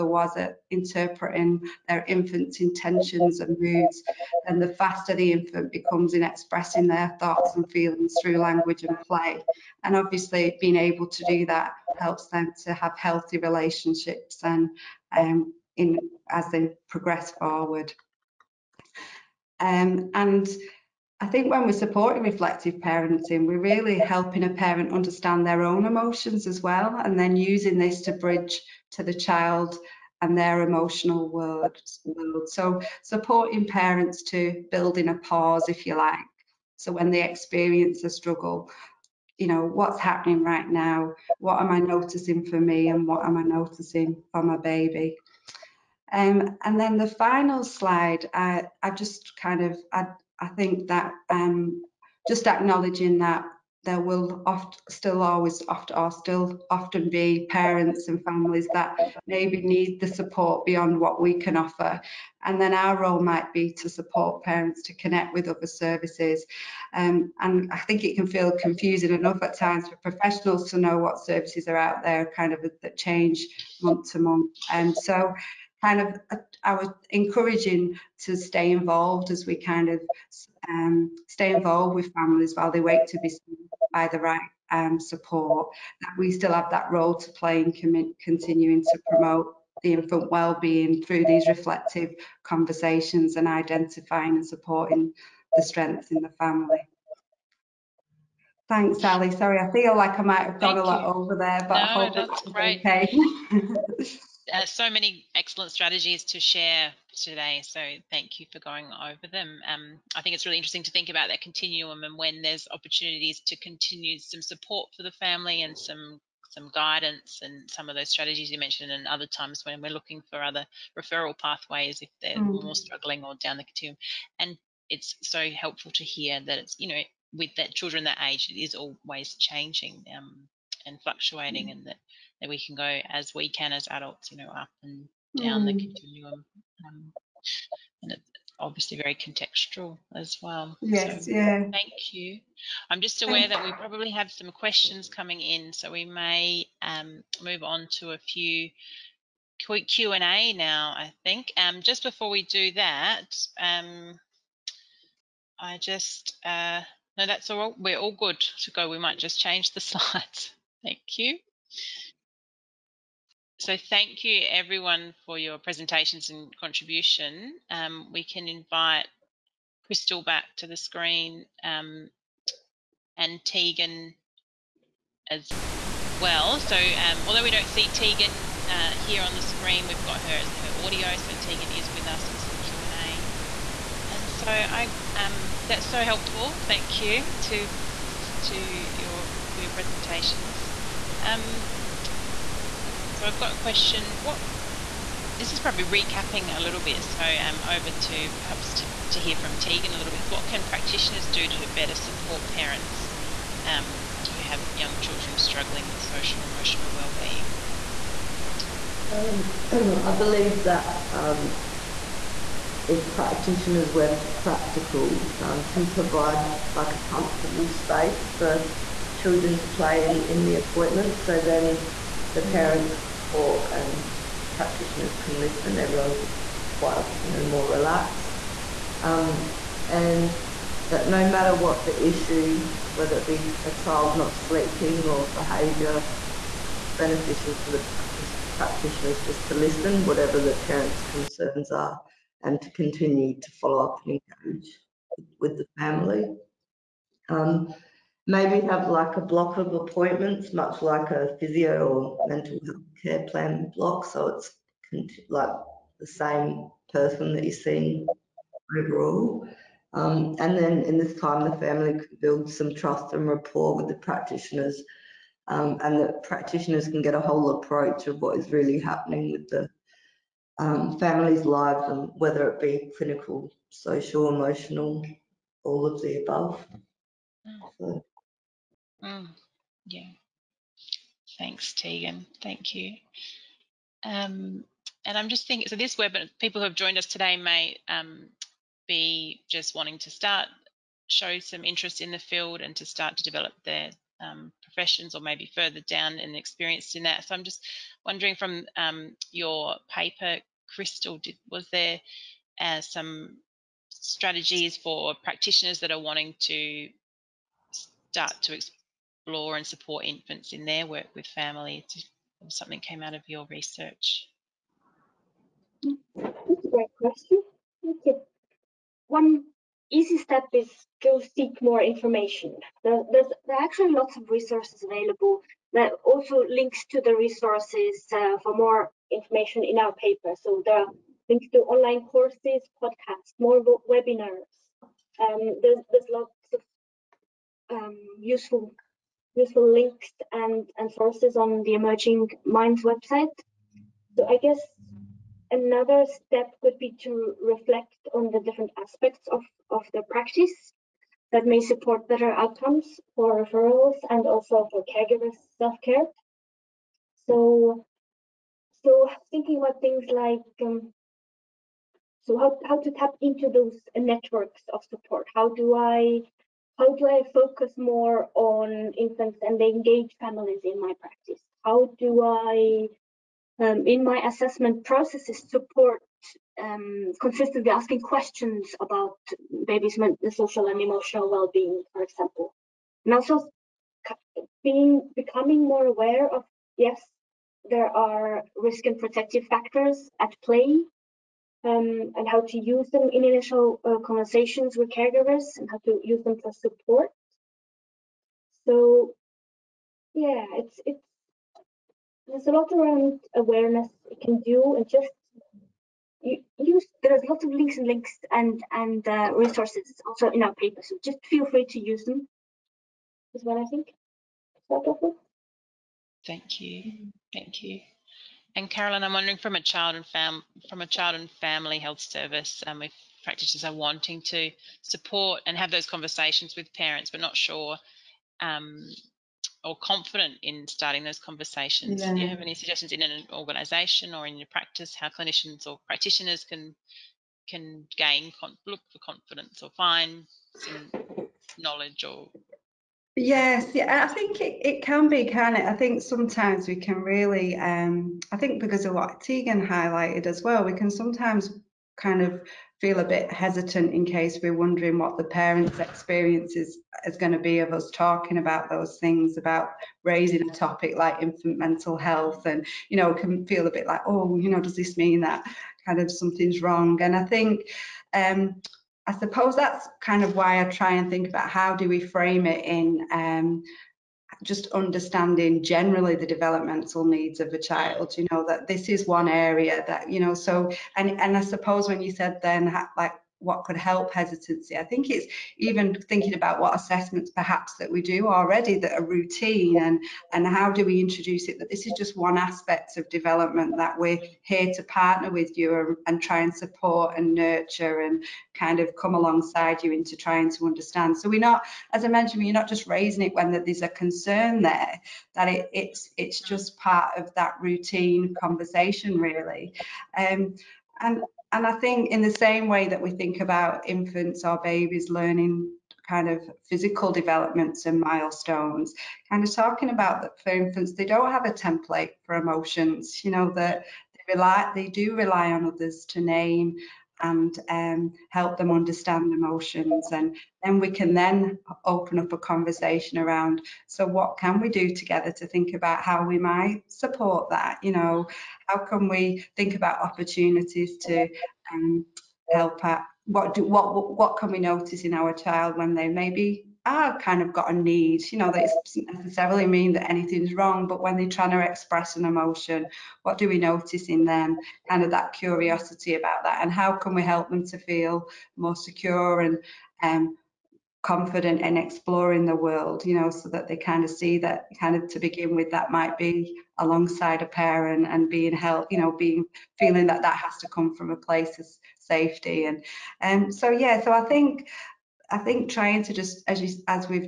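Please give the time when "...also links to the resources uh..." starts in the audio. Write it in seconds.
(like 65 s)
326 s.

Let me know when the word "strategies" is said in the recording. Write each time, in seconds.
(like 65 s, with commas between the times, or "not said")
105 s, 118 s, 303 s.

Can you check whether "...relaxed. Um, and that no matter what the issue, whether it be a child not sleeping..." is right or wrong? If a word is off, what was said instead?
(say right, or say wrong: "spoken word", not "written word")
right.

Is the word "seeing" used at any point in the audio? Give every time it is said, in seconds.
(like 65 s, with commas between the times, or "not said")
257 s.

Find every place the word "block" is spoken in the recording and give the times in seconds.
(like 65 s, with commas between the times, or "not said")
249 s, 253 s.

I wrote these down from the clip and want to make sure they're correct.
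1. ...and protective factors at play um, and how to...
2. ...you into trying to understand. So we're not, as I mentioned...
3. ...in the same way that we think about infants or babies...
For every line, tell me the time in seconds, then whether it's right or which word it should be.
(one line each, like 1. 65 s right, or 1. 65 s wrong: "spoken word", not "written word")
1. 388 s right
2. 499 s right
3. 512 s right.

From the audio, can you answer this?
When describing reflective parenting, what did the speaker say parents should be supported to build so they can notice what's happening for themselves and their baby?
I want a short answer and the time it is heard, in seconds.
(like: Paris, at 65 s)
A pause, at 35 s.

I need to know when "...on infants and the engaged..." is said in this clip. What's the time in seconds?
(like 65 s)
368 s.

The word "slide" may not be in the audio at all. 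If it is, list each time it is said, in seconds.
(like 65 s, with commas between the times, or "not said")
47 s, 159 s.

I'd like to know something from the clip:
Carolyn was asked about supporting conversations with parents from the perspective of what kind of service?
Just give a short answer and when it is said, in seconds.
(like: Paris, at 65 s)
Child and family health service, at 420 s.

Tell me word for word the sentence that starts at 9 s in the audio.
And obviously being able to do that helps them to have healthy relationships and um, in as they progress forward.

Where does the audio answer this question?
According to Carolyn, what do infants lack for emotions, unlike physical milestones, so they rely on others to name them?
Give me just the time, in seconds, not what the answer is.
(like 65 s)
521 s.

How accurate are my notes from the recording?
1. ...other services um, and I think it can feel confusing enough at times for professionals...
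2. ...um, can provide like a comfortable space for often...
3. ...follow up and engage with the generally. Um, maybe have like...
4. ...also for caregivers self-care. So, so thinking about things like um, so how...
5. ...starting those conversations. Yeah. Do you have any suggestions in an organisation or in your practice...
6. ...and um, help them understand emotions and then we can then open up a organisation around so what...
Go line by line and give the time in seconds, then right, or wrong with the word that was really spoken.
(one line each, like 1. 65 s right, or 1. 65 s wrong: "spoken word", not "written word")
1. 65 s right
2. 215 s wrong: "children", not "often"
3. 243 s wrong: "family", not "generally"
4. 354 s right
5. 430 s right
6. 527 s wrong: "conversation", not "organisation".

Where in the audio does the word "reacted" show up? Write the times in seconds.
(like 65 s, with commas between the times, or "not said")
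not said.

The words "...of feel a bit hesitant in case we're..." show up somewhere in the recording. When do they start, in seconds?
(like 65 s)
452 s.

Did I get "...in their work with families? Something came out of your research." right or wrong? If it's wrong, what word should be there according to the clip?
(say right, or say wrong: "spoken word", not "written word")
right.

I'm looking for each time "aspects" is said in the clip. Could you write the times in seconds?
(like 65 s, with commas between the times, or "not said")
348 s, 492 s.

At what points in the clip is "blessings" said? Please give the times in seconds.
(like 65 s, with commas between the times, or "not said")
not said.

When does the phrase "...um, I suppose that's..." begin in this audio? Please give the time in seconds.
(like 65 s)
468 s.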